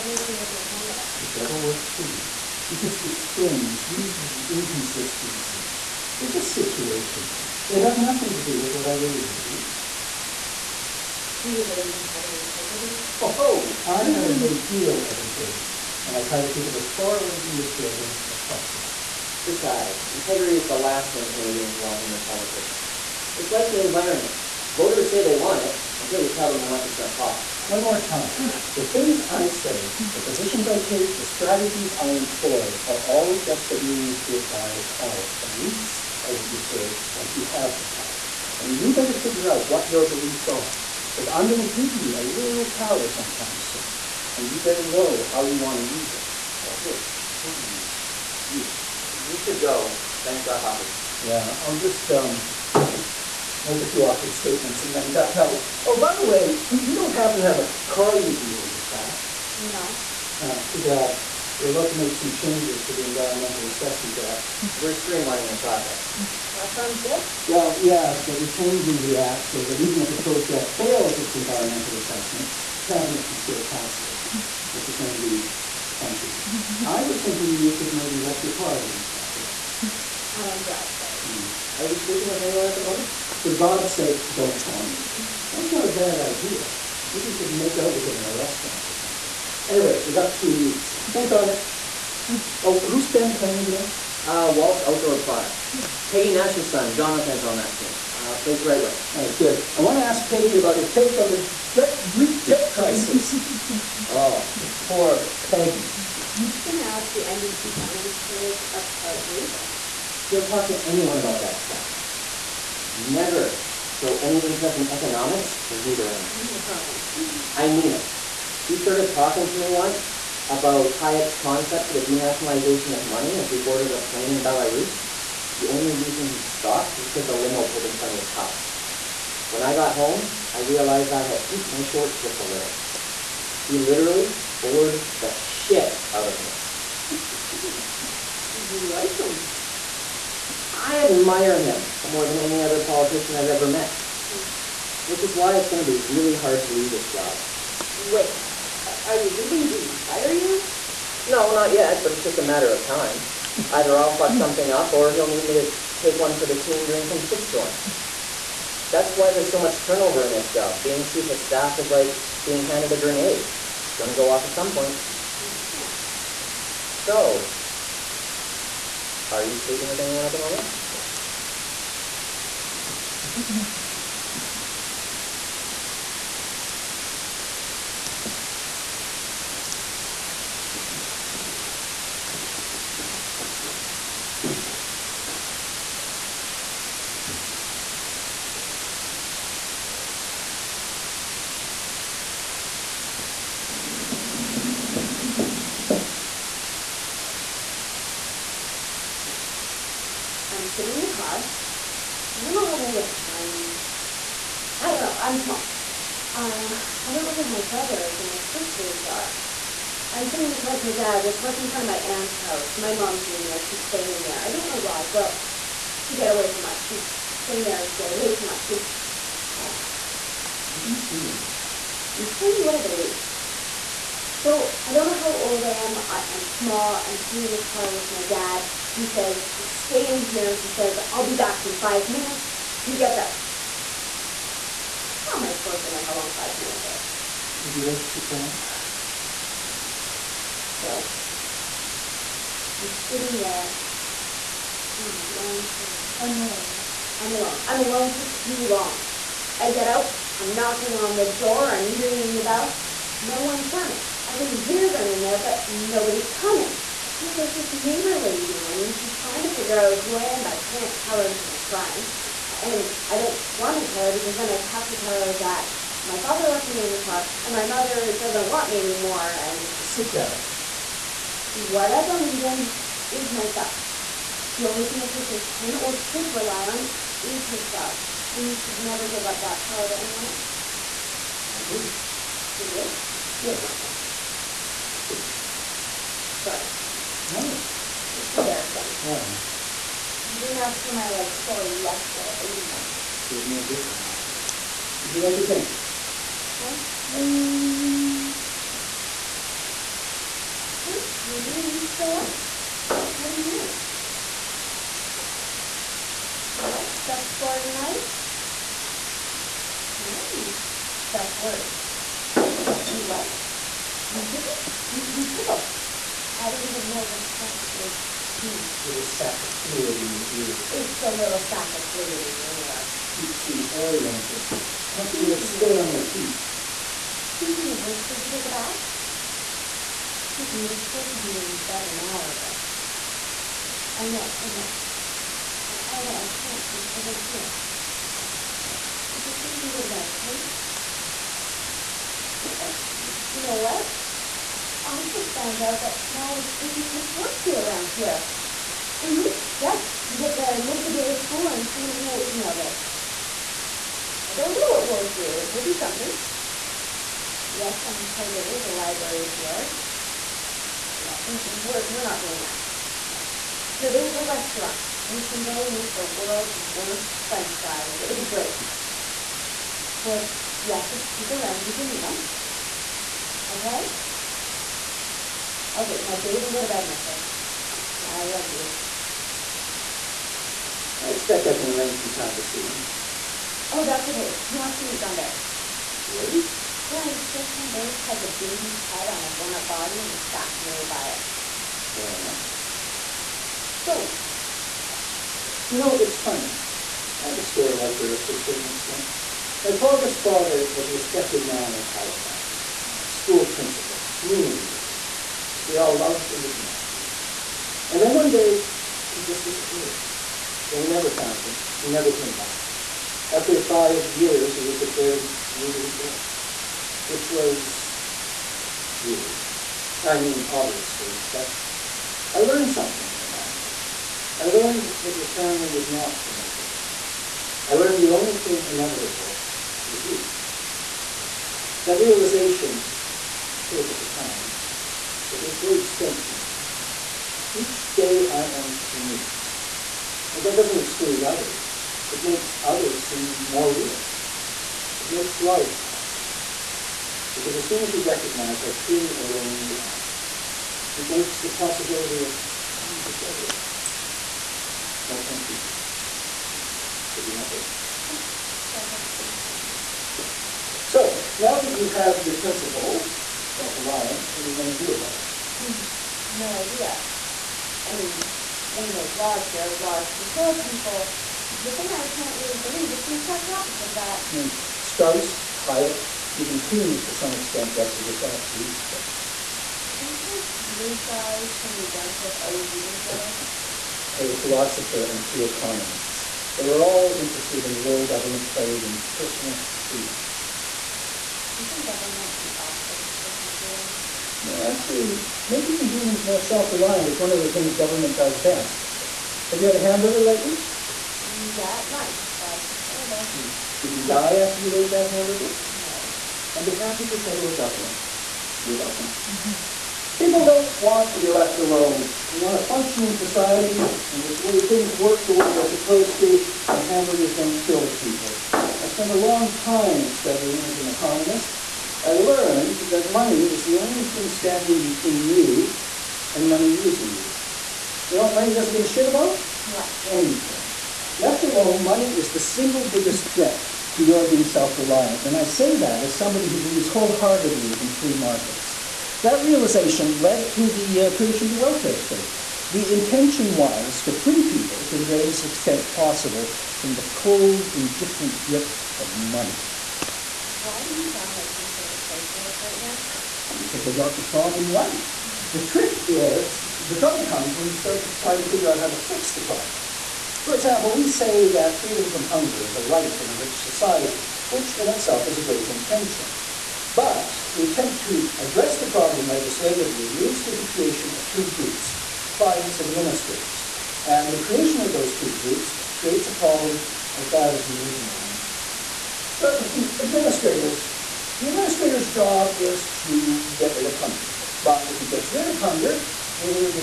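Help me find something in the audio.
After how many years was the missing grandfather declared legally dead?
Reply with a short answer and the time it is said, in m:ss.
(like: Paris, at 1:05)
5, at 6:53.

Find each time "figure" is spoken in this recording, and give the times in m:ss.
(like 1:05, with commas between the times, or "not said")
0:39, 4:19, 9:18.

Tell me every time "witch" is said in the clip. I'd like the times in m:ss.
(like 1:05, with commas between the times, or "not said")
not said.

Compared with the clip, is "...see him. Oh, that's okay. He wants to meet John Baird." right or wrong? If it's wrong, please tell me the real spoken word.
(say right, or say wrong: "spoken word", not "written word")
right.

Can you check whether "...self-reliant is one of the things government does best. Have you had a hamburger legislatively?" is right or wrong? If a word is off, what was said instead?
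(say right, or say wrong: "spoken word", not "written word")
wrong: "lately", not "legislatively".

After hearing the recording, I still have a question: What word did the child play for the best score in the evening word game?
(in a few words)
utricle.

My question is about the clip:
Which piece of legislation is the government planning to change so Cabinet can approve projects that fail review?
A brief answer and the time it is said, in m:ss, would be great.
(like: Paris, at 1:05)
Environmental Assessment Act, at 1:03.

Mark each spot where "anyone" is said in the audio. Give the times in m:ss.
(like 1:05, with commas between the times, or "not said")
1:22, 1:50, 2:50, 4:39.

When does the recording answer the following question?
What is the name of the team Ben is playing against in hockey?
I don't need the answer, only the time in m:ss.
1:34.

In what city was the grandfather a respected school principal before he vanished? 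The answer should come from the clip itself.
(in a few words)
Halifax.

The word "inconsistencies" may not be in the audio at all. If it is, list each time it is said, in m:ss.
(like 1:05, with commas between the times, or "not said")
0:04.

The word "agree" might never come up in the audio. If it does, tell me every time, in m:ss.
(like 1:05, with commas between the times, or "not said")
4:41.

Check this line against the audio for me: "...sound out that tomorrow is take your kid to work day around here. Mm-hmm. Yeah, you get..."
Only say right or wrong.
wrong.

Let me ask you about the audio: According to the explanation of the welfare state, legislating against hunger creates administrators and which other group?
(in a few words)
clients.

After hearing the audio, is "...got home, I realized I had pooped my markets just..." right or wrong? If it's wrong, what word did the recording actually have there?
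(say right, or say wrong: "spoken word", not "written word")
wrong: "shorts", not "markets".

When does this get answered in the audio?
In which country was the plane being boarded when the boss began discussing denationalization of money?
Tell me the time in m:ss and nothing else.
2:04.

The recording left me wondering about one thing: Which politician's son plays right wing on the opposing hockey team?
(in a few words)
Peggy Nash.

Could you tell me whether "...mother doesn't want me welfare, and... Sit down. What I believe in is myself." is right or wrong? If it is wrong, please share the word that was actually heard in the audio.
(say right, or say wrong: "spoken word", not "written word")
wrong: "anymore", not "welfare".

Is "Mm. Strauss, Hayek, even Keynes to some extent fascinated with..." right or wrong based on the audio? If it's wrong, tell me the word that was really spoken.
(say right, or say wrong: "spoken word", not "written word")
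wrong: "wrestled", not "fascinated".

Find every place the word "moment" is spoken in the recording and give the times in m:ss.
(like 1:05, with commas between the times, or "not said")
1:22, 2:50.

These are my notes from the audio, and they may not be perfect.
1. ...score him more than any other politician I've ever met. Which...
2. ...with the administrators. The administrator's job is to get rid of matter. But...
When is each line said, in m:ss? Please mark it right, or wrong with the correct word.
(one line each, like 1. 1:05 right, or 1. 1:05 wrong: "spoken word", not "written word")
1. 2:21 wrong: "admire", not "score"
2. 9:39 wrong: "hunger", not "matter".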